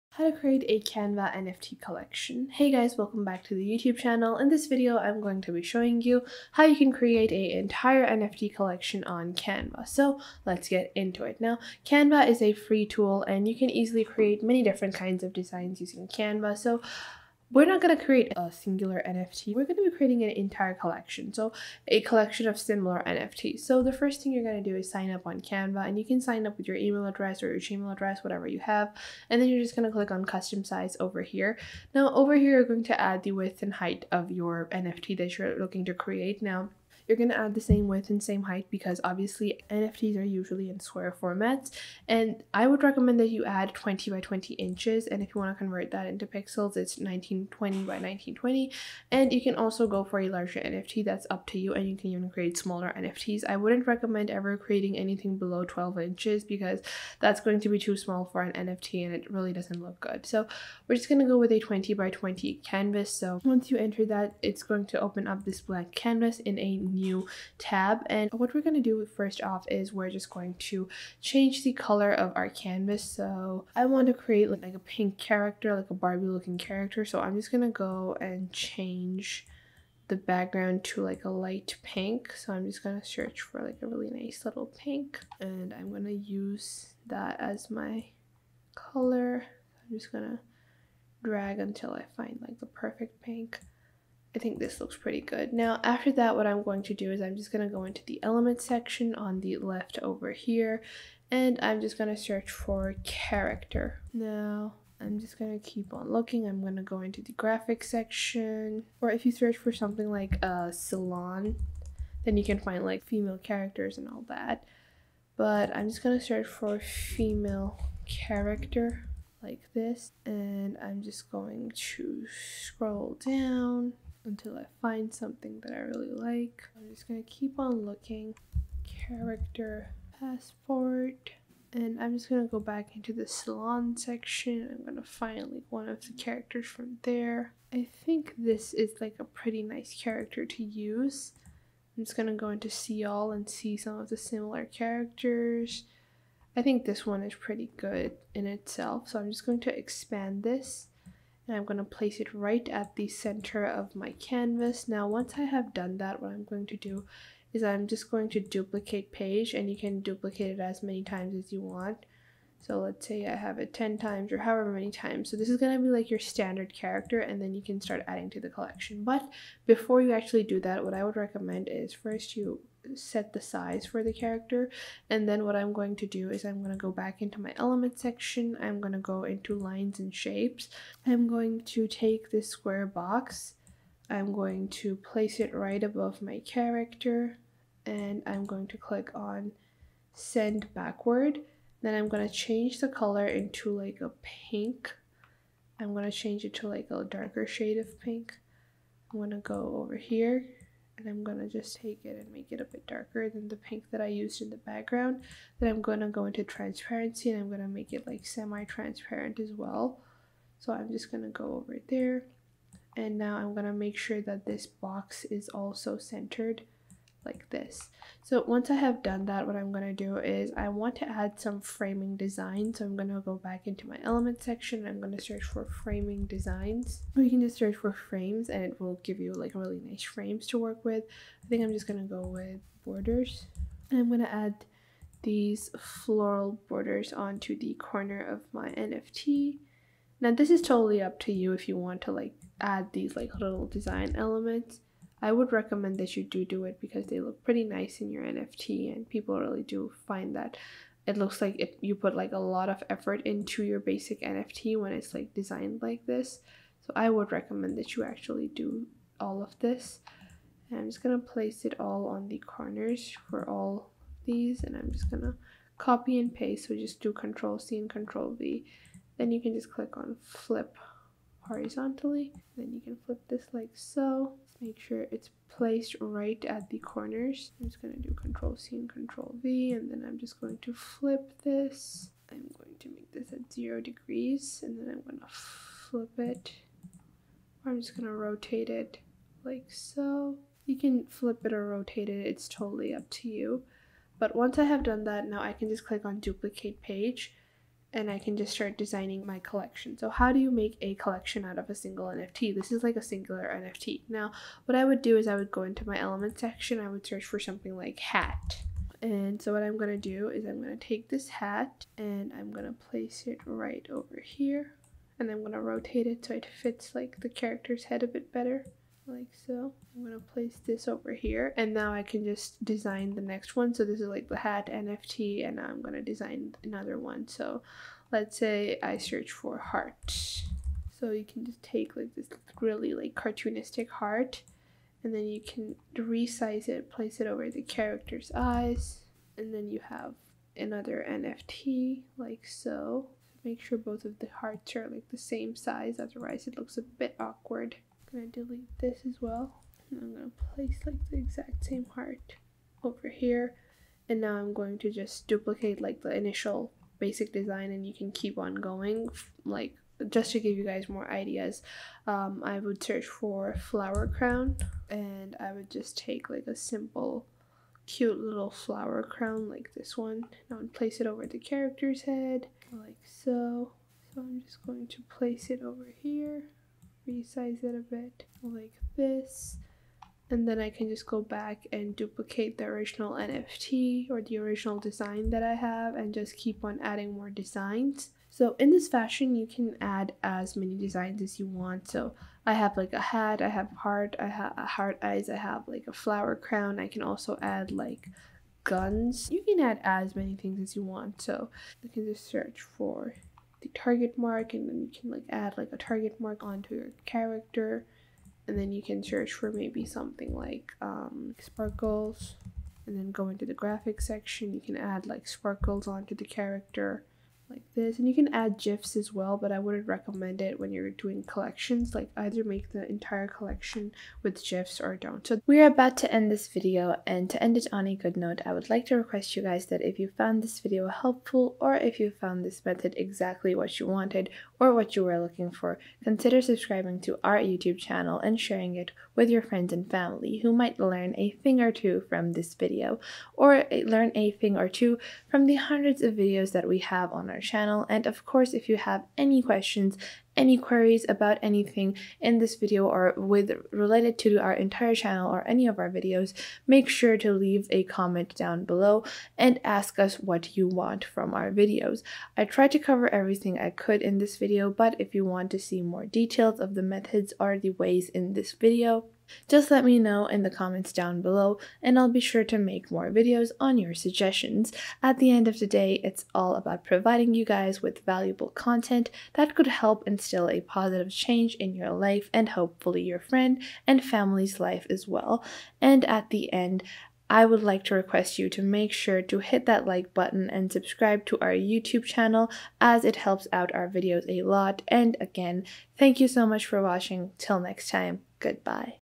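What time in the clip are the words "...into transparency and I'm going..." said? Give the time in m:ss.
3:26.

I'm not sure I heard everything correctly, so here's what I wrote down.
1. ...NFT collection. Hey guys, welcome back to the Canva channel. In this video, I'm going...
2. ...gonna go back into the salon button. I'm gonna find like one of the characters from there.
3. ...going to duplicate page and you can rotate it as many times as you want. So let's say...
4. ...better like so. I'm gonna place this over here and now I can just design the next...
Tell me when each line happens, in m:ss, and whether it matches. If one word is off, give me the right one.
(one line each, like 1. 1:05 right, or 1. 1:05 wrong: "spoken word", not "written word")
1. 0:01 wrong: "YouTube", not "Canva"
2. 2:12 wrong: "section", not "button"
3. 2:38 wrong: "duplicate", not "rotate"
4. 5:18 right.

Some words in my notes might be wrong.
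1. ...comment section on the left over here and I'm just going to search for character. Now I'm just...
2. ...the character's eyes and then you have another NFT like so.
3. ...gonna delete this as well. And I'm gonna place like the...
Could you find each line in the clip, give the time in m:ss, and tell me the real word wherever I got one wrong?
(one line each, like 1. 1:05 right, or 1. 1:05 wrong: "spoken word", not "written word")
1. 1:38 wrong: "element", not "comment"
2. 5:37 right
3. 5:48 right.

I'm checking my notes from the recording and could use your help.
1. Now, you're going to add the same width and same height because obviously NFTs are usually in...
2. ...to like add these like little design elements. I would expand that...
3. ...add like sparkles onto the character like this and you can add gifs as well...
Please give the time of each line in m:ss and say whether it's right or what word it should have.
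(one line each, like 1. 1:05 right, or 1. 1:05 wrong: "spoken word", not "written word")
1. 0:36 right
2. 4:02 wrong: "recommend", not "expand"
3. 6:54 right.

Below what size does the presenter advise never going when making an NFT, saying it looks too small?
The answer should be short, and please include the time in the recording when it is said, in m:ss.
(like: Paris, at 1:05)
12 inches, at 0:55.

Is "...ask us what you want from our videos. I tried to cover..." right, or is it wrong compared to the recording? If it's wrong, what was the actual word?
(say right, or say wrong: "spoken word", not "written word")
right.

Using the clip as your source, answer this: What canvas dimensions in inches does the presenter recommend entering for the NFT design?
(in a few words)
20 by 20 inches.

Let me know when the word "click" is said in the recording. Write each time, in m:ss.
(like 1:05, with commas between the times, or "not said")
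0:29, 3:08, 4:29, 4:55.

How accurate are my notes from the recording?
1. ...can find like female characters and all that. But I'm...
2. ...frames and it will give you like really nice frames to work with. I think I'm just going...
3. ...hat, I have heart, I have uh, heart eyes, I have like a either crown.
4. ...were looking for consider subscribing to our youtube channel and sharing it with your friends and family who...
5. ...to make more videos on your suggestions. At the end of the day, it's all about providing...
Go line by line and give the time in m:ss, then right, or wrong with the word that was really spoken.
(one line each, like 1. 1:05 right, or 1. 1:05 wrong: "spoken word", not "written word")
1. 1:52 right
2. 3:47 right
3. 6:33 wrong: "flower", not "either"
4. 7:15 right
5. 7:52 right.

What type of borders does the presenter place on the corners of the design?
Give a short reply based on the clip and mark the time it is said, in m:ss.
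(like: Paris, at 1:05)
floral borders, at 3:55.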